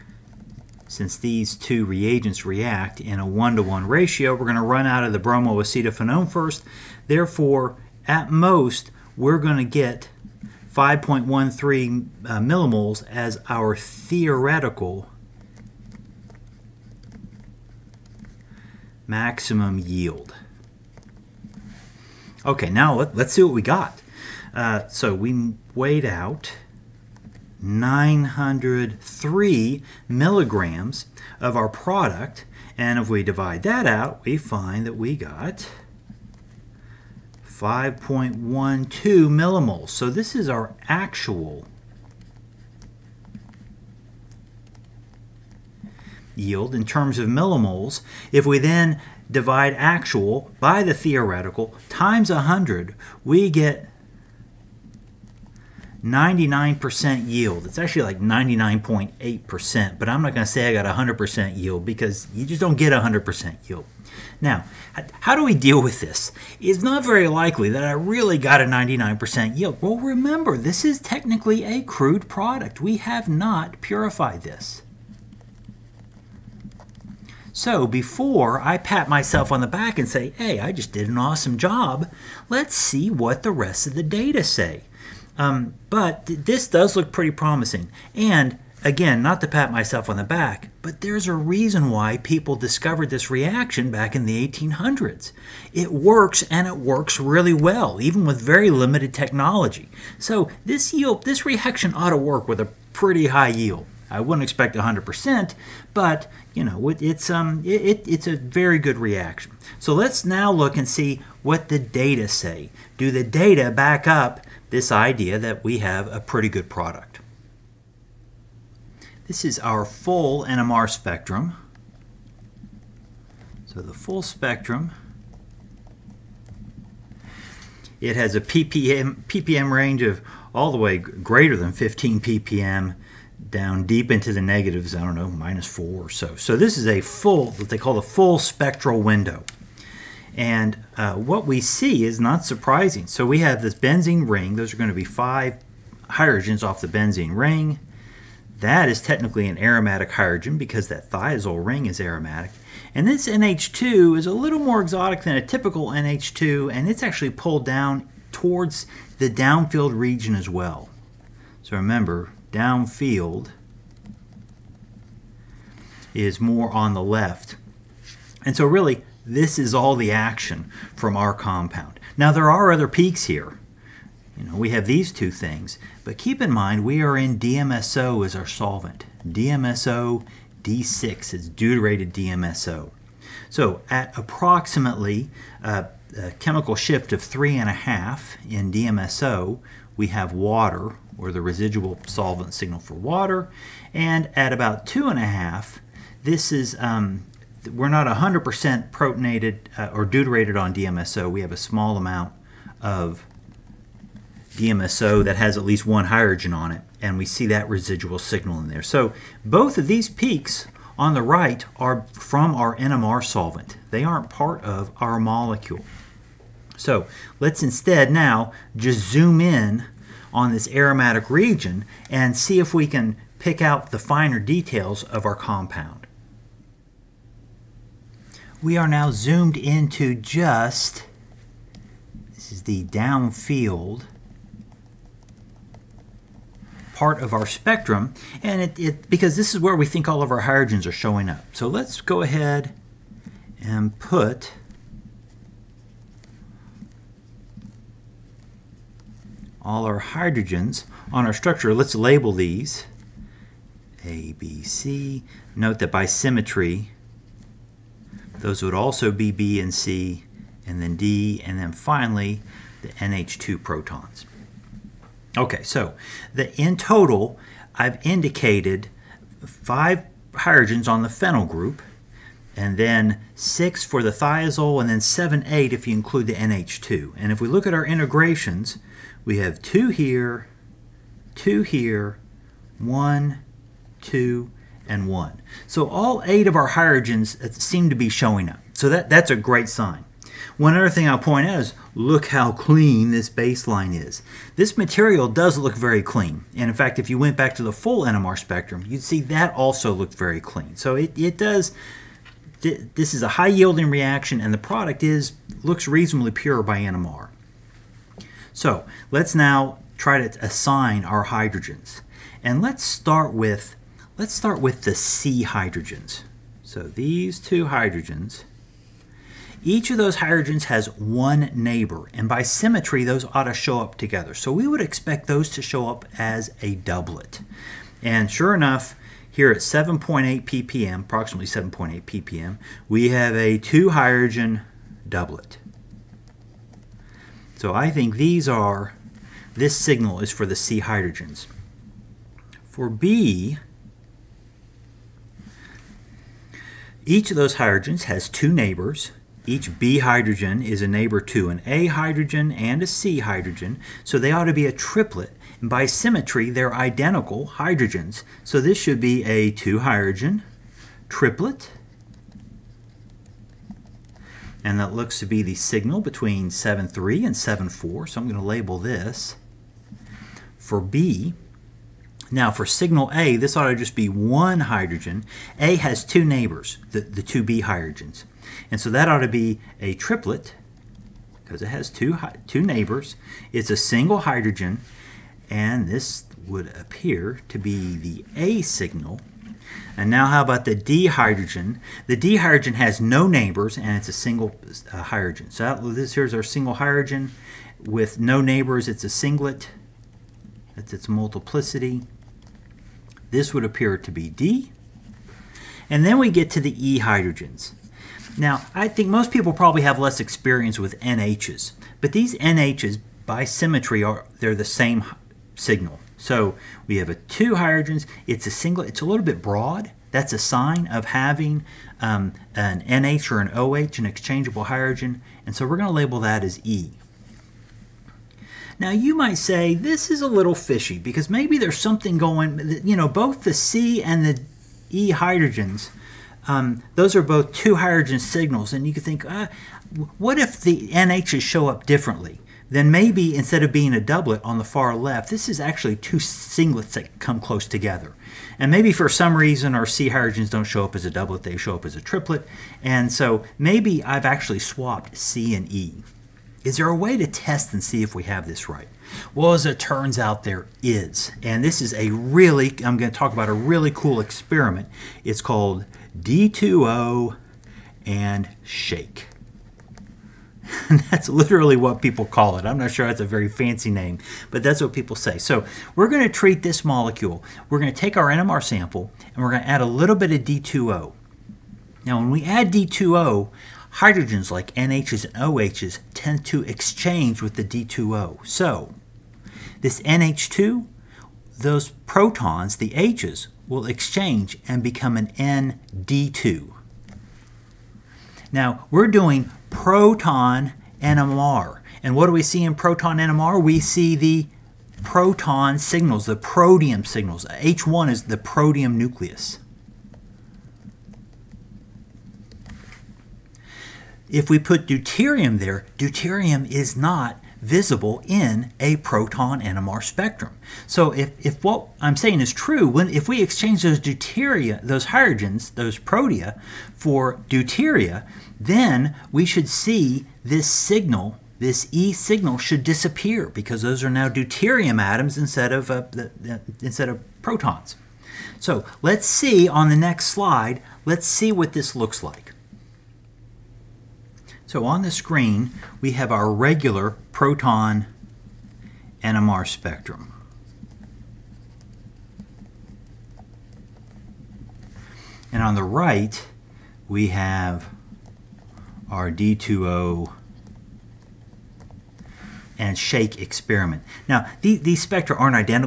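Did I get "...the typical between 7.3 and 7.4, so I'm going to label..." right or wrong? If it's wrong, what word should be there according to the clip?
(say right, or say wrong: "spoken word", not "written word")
wrong: "signal", not "typical".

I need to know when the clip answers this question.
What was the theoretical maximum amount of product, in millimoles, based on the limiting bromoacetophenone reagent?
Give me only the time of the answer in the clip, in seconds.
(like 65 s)
10 s.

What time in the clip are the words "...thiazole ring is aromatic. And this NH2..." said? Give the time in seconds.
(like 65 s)
151 s.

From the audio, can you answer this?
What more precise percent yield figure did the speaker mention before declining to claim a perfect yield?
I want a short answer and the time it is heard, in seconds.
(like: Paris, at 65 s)
99.8%, at 58 s.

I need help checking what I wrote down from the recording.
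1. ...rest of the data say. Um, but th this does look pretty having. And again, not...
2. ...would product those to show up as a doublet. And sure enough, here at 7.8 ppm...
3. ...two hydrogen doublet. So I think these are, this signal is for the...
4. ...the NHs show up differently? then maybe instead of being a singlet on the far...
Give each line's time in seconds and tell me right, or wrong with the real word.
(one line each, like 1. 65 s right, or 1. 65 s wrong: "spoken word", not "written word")
1. 83 s wrong: "promising", not "having"
2. 324 s wrong: "expect", not "product"
3. 333 s right
4. 440 s wrong: "doublet", not "singlet".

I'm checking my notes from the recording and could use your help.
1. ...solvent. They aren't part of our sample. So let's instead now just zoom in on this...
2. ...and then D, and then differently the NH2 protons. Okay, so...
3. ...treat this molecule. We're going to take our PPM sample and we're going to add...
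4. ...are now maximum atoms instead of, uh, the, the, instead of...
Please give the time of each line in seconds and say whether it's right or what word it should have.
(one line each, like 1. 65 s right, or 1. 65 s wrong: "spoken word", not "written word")
1. 213 s wrong: "molecule", not "sample"
2. 260 s wrong: "finally", not "differently"
3. 476 s wrong: "NMR", not "PPM"
4. 534 s wrong: "deuterium", not "maximum".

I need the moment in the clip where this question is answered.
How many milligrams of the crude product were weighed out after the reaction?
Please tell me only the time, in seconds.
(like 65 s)
27 s.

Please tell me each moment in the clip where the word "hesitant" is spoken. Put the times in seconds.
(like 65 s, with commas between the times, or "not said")
not said.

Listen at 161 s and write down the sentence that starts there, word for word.
So remember, downfield is more on the left.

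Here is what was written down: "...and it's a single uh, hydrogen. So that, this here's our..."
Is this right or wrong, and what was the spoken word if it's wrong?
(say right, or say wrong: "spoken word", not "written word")
right.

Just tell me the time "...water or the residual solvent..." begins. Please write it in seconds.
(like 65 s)
190 s.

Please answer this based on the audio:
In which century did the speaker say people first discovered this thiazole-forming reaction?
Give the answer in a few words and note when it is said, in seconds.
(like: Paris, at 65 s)
1800s, at 94 s.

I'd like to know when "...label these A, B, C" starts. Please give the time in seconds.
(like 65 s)
251 s.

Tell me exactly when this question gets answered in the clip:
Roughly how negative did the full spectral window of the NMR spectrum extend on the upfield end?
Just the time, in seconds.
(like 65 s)
135 s.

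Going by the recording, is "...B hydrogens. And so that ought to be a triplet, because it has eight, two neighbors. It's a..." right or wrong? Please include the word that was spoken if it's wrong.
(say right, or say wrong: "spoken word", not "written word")
wrong: "two", not "eight".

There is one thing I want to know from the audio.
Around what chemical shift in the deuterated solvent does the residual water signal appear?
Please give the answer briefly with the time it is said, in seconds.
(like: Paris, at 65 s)
3.5, at 187 s.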